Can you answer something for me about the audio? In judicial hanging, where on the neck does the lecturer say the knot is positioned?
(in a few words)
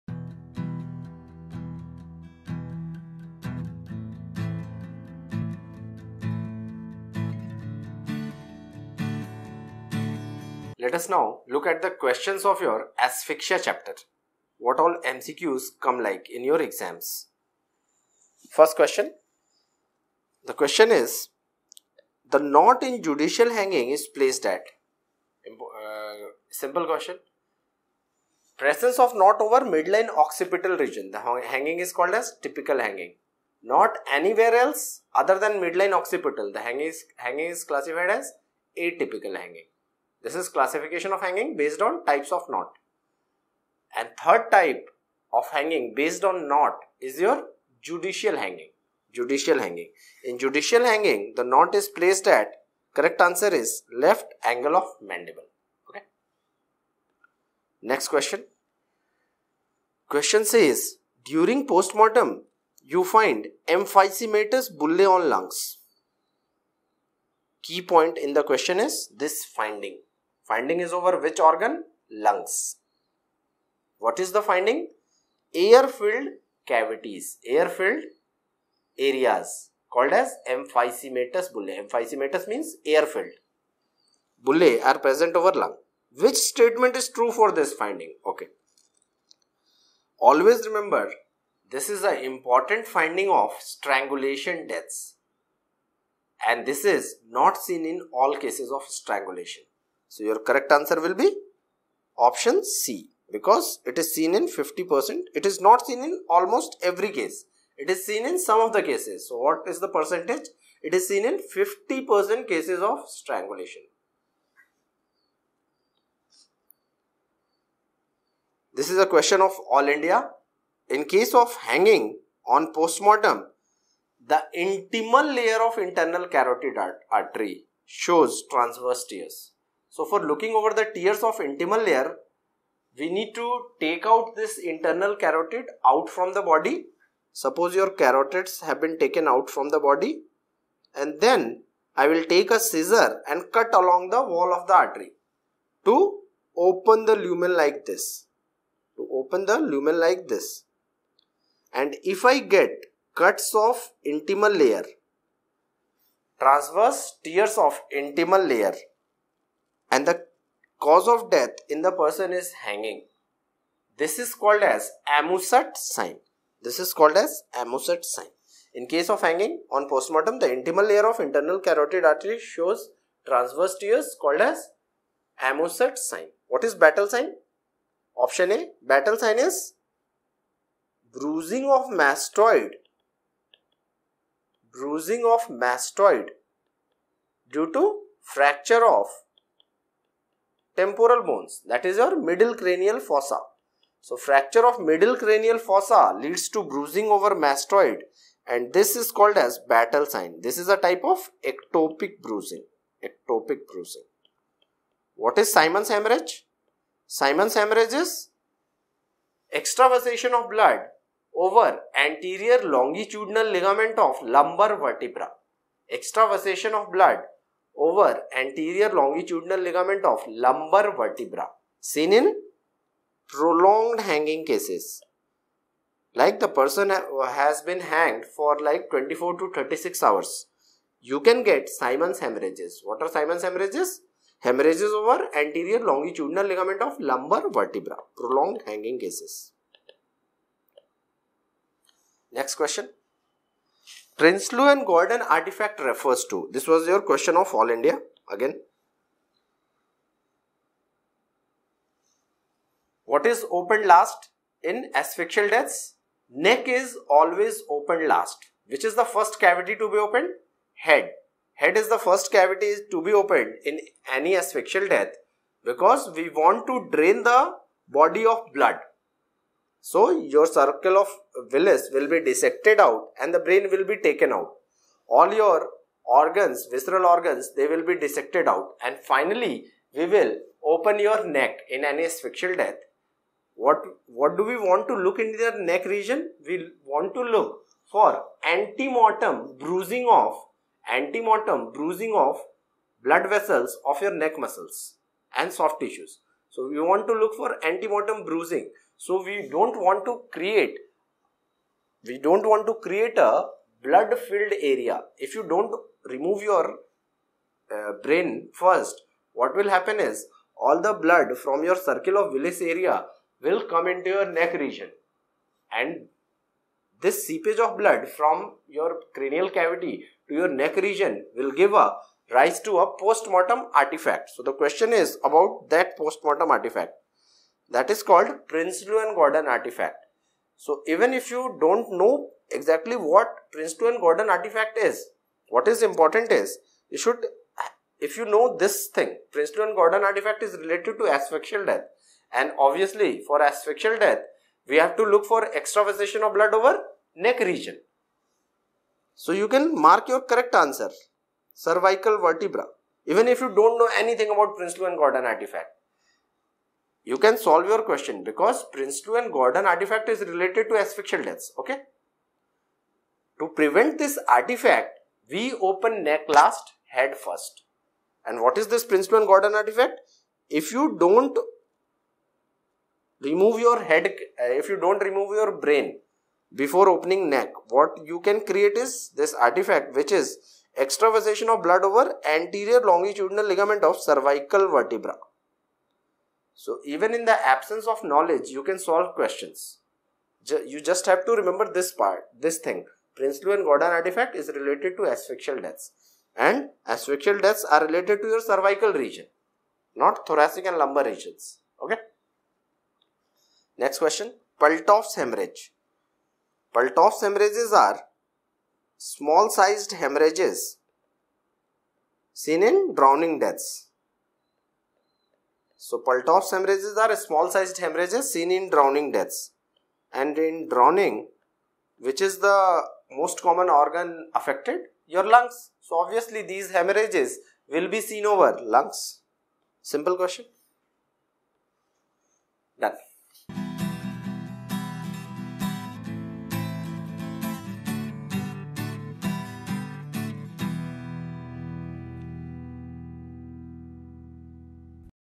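Left angle of mandible.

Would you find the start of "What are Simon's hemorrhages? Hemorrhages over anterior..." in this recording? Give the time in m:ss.
3:52.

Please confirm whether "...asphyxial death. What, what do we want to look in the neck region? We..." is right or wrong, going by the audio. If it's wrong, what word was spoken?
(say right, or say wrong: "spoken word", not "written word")
right.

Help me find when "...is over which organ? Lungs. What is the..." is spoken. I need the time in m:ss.
1:10.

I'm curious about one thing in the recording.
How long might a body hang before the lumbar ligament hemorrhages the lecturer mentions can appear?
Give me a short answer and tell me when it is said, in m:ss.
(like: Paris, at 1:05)
24 to 36 hours, at 3:48.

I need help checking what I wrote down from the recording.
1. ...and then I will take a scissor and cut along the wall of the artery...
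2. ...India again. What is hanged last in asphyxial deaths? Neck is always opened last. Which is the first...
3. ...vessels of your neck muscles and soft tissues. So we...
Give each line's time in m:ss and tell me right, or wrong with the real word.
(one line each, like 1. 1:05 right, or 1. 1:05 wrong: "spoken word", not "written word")
1. 2:20 right
2. 4:07 wrong: "opened", not "hanged"
3. 4:53 right.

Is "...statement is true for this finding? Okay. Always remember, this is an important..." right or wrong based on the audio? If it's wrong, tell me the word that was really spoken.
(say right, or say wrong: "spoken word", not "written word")
right.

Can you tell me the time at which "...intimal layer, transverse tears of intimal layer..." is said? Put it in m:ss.
2:34.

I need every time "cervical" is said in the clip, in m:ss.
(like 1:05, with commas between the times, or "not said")
5:51, 6:23, 6:38.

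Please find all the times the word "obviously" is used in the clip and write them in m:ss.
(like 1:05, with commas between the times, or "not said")
5:42, 7:05.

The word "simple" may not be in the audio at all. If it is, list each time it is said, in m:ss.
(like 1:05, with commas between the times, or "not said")
0:26, 7:09.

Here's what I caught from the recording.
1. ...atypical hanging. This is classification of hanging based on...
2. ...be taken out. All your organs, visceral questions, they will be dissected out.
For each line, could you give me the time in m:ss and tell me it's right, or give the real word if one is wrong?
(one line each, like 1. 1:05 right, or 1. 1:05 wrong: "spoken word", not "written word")
1. 0:38 right
2. 4:33 wrong: "organs", not "questions".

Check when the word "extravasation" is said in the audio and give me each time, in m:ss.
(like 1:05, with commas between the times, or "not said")
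3:29, 3:35, 5:45, 6:20.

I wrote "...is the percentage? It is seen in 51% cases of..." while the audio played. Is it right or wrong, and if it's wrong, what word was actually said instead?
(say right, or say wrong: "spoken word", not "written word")
wrong: "50", not "51".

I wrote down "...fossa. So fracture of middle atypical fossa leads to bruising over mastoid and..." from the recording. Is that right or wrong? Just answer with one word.
wrong.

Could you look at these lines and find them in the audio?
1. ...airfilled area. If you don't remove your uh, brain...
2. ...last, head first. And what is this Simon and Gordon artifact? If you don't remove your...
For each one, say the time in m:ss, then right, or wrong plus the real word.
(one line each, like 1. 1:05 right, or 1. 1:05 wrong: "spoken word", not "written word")
1. 5:04 wrong: "filled", not "airfilled"
2. 6:06 wrong: "Prinsloo", not "Simon".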